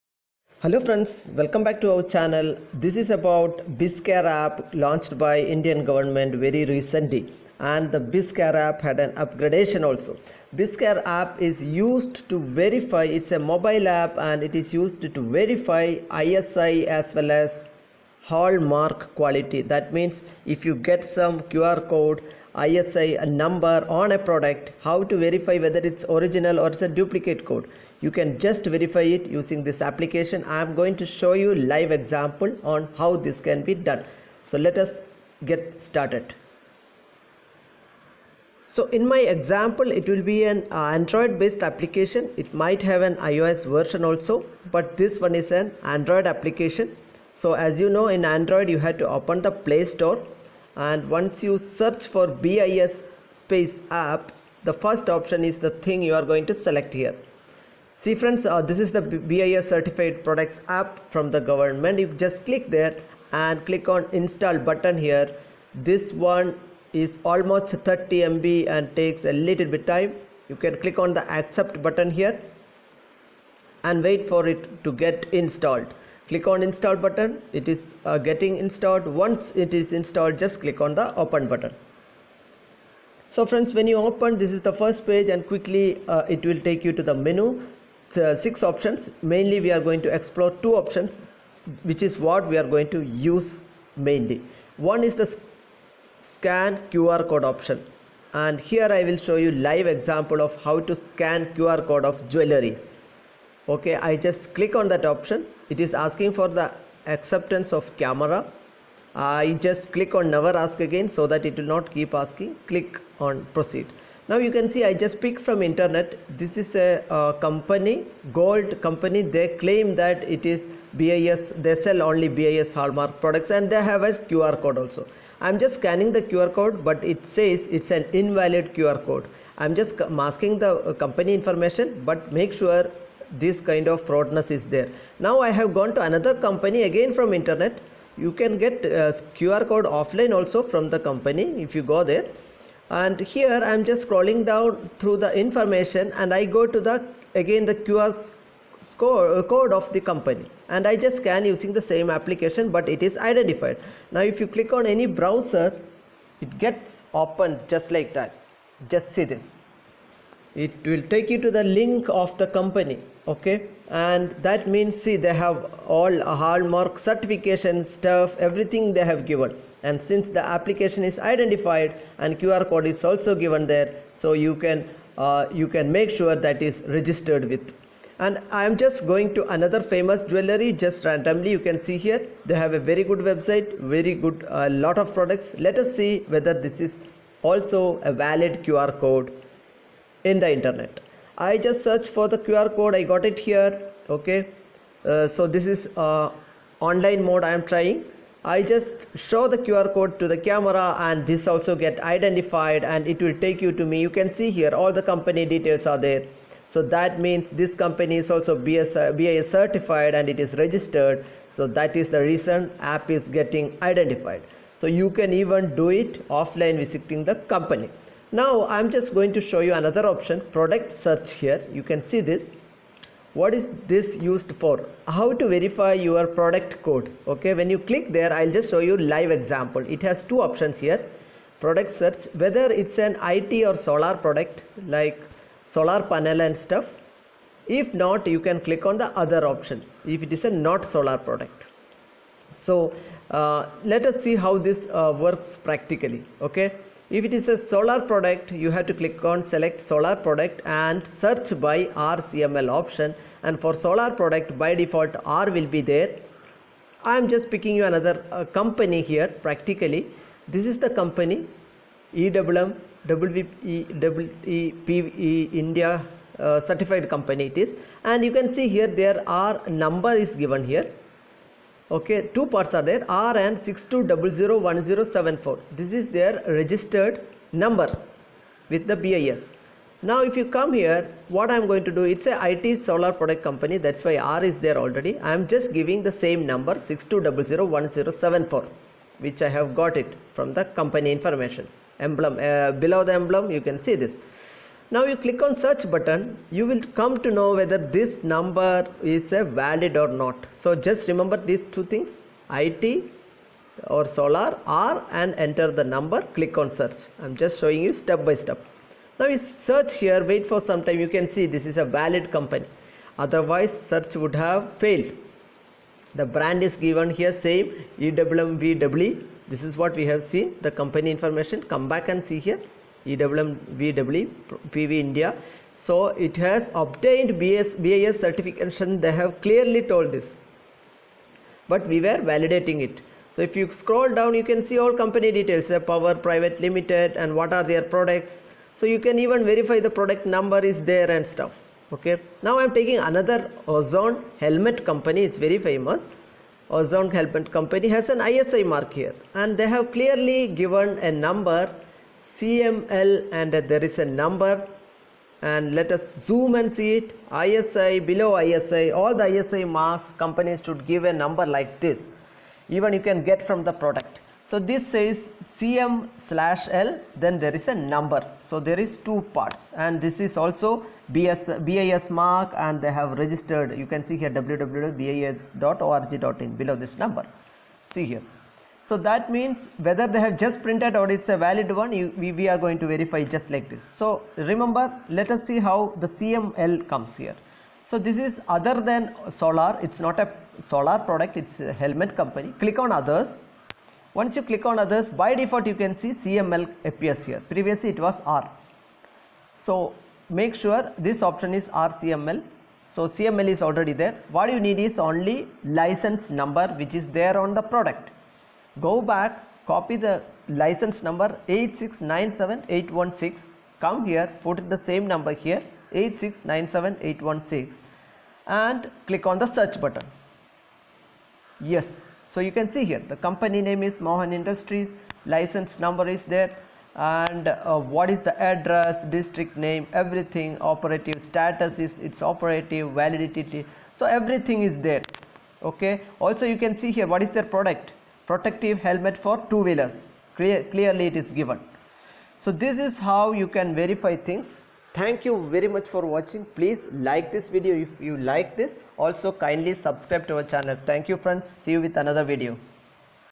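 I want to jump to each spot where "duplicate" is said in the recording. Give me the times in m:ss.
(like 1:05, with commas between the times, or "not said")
0:26.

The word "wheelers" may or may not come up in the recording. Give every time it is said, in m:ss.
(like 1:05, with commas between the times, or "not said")
7:19.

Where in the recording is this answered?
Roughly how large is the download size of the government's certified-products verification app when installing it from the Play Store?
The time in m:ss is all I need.
1:07.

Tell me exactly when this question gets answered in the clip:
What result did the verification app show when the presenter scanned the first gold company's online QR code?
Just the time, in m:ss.
2:08.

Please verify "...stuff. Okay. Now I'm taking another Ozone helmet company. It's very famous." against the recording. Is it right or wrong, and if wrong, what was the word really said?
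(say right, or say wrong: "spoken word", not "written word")
right.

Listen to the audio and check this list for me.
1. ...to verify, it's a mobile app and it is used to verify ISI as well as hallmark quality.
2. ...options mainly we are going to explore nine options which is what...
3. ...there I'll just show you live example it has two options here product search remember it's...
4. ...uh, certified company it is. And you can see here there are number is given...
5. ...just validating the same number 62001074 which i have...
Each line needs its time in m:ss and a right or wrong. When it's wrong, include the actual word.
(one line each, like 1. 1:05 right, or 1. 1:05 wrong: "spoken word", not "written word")
1. 0:12 right
2. 1:28 wrong: "two", not "nine"
3. 3:48 wrong: "whether", not "remember"
4. 4:26 right
5. 4:45 wrong: "giving", not "validating".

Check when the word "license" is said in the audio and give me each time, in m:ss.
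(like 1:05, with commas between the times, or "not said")
6:45, 6:50, 7:05.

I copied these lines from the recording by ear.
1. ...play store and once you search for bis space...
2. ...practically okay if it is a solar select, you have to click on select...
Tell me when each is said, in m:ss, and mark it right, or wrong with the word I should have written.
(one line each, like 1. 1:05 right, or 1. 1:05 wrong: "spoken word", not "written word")
1. 0:49 right
2. 4:05 wrong: "product", not "select".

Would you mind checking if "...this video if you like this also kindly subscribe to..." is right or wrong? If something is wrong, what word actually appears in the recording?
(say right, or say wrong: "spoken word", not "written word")
right.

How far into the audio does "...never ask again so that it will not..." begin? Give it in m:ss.
1:50.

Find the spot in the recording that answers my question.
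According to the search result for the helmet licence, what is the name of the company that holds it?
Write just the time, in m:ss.
7:03.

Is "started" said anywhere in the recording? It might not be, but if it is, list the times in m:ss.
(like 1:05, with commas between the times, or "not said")
0:35.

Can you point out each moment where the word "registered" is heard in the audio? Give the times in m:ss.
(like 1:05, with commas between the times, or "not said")
2:56, 3:30, 4:36, 6:13.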